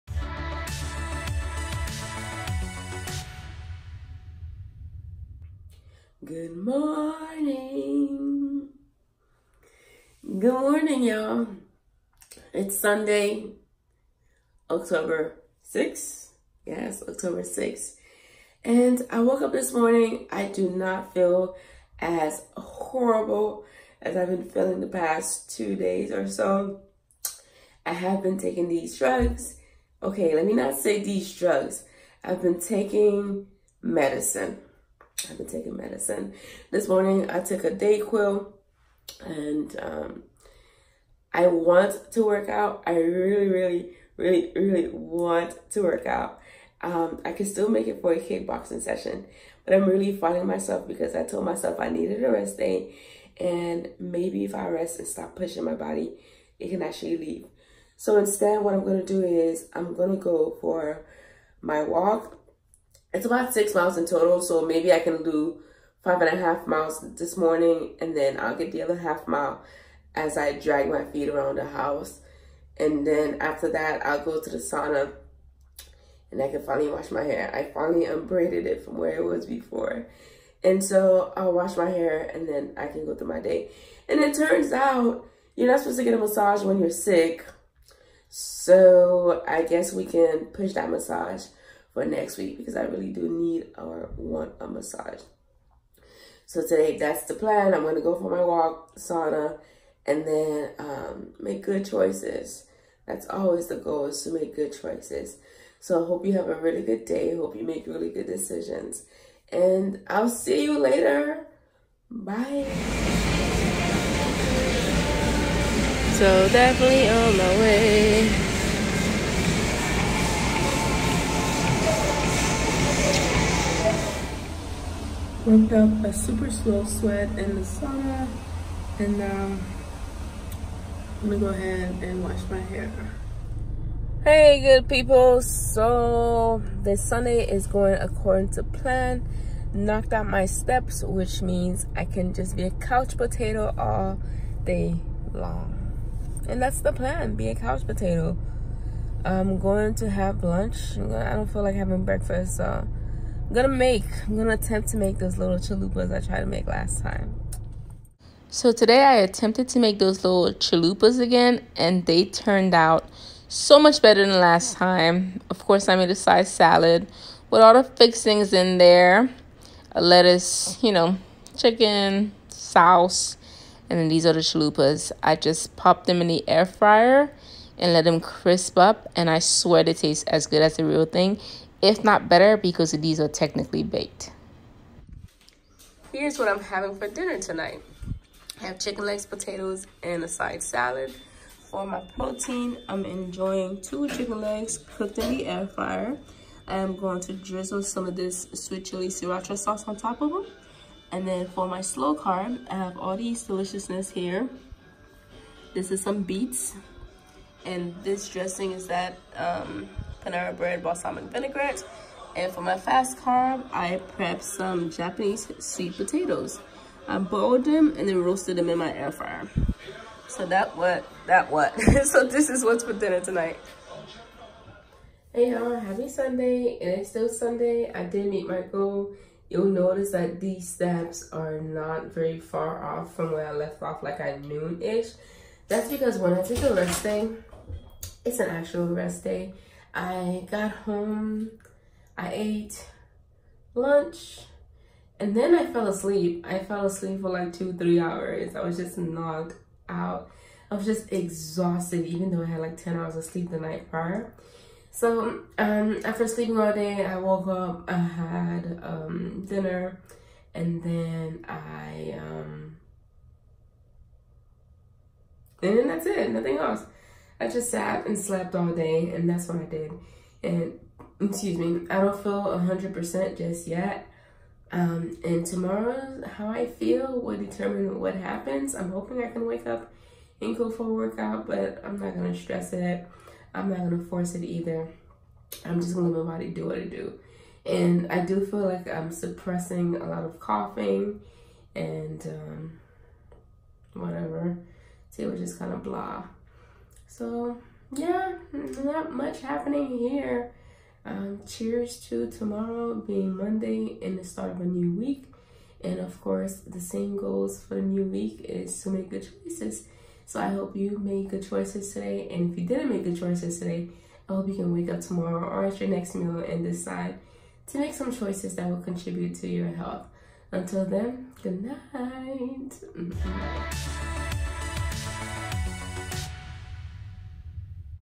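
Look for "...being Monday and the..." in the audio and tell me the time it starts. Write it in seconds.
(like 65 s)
302 s.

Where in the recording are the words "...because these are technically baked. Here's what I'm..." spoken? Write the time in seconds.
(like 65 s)
182 s.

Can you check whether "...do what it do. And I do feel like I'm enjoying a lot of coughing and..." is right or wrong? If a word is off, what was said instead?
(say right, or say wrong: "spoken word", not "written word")
wrong: "suppressing", not "enjoying".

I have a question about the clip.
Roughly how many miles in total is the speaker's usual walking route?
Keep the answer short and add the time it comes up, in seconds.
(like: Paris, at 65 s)
6, at 63 s.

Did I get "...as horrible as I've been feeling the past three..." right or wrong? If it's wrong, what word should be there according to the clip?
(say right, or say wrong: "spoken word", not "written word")
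wrong: "two", not "three".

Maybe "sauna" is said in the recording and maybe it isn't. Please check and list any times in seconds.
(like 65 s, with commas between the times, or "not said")
74 s, 98 s, 127 s.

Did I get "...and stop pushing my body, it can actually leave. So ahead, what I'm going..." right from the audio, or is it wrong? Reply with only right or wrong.
wrong.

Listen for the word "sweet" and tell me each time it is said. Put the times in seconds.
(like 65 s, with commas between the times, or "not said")
198 s, 215 s.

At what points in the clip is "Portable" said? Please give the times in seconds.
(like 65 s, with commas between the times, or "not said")
not said.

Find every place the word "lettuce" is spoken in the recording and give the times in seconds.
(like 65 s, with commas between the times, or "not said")
170 s.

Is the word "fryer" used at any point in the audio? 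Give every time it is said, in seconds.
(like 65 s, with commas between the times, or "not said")
176 s, 195 s, 219 s.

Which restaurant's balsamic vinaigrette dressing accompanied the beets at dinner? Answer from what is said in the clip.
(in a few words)
Panera Bread.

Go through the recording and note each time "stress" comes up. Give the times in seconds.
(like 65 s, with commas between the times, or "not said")
282 s.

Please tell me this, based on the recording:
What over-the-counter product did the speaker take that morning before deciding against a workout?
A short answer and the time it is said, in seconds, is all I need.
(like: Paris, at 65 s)
Dayquil, at 37 s.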